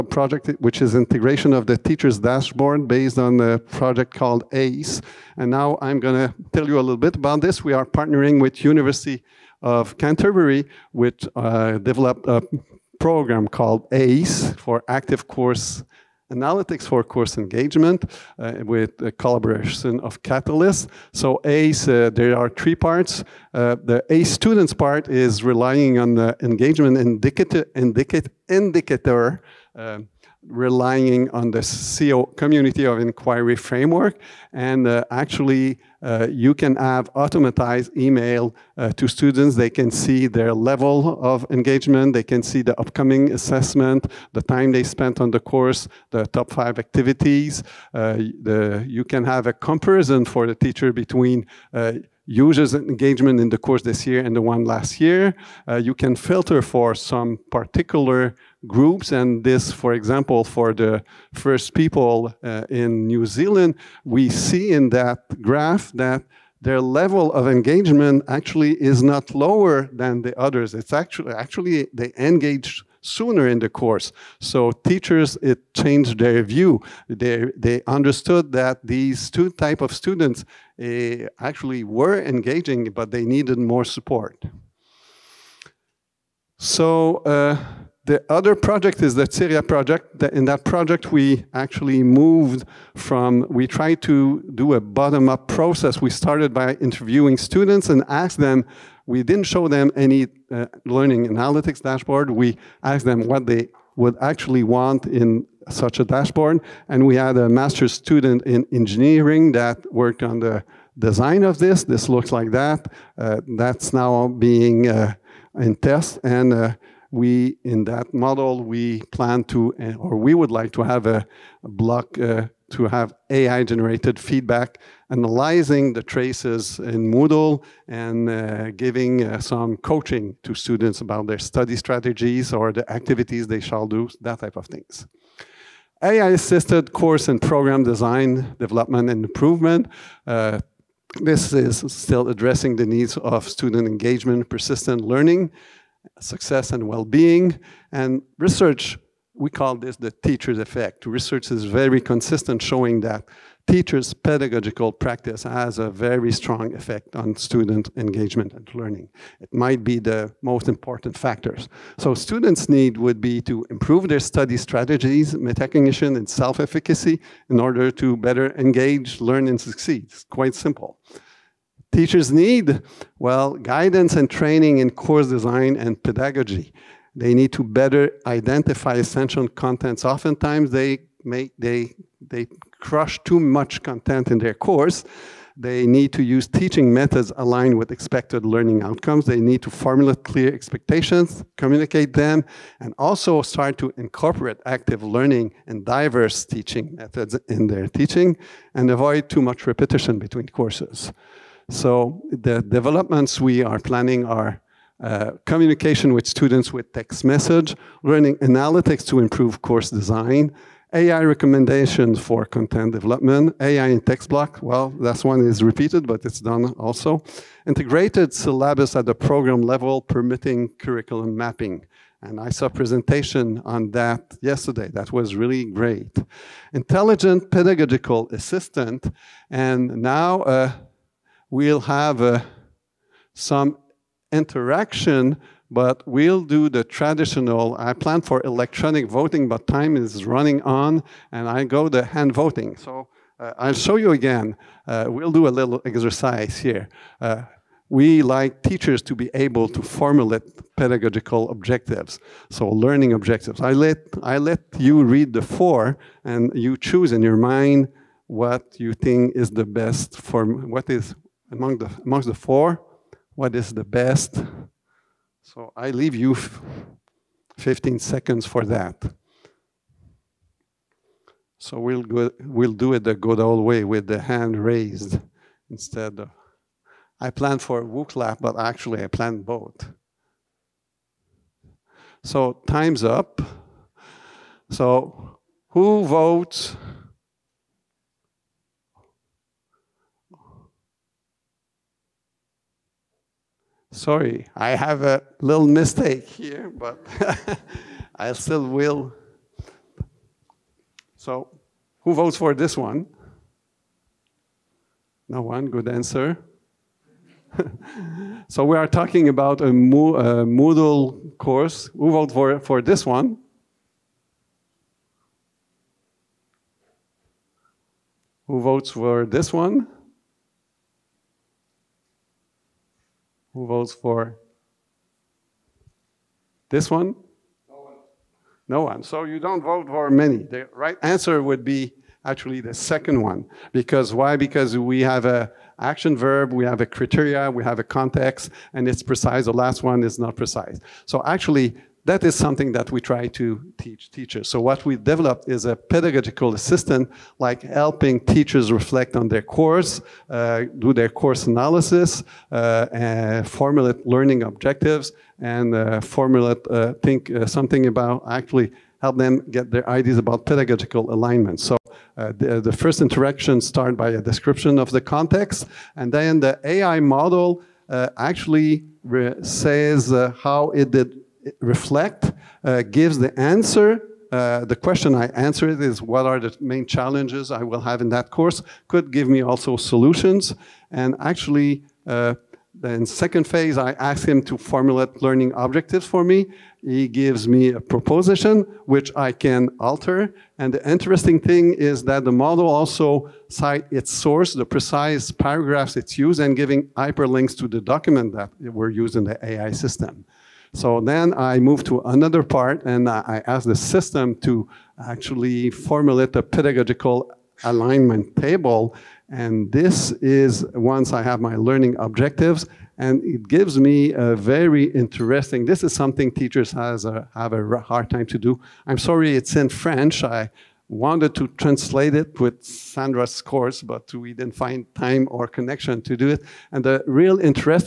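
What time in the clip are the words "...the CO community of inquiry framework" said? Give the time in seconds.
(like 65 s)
31 s.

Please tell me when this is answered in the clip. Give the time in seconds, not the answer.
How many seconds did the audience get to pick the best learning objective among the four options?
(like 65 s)
267 s.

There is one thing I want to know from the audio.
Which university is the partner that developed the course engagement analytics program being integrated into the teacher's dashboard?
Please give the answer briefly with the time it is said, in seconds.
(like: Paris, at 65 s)
University of Canterbury, at 8 s.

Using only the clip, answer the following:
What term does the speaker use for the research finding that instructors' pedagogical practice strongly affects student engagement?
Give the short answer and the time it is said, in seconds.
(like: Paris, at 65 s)
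the teacher's effect, at 149 s.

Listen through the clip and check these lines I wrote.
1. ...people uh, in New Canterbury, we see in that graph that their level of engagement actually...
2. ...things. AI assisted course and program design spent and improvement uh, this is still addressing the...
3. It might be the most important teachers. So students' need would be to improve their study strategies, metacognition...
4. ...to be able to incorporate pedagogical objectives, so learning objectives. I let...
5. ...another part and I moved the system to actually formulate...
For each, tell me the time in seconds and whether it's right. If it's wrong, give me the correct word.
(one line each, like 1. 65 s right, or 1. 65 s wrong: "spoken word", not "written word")
1. 61 s wrong: "Zealand", not "Canterbury"
2. 134 s wrong: "development", not "spent"
3. 159 s wrong: "factors", not "teachers"
4. 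249 s wrong: "formulate", not "incorporate"
5. 402 s wrong: "asked", not "moved".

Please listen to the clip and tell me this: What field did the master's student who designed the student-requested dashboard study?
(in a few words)
engineering.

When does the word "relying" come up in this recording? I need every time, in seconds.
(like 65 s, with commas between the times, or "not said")
25 s, 30 s.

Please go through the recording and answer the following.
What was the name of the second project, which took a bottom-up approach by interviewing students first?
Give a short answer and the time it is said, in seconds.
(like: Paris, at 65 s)
Syria, at 89 s.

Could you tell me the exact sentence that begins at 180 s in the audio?
Oftentimes, they make they they crush too much content in their course.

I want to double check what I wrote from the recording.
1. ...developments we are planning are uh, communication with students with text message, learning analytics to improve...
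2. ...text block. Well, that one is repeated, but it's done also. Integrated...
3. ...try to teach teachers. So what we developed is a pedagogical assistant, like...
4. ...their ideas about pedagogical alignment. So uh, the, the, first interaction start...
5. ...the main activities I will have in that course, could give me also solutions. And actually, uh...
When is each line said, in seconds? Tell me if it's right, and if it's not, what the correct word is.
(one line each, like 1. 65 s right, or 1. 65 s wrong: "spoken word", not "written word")
1. 202 s right
2. 213 s right
3. 342 s right
4. 359 s right
5. 376 s wrong: "challenges", not "activities".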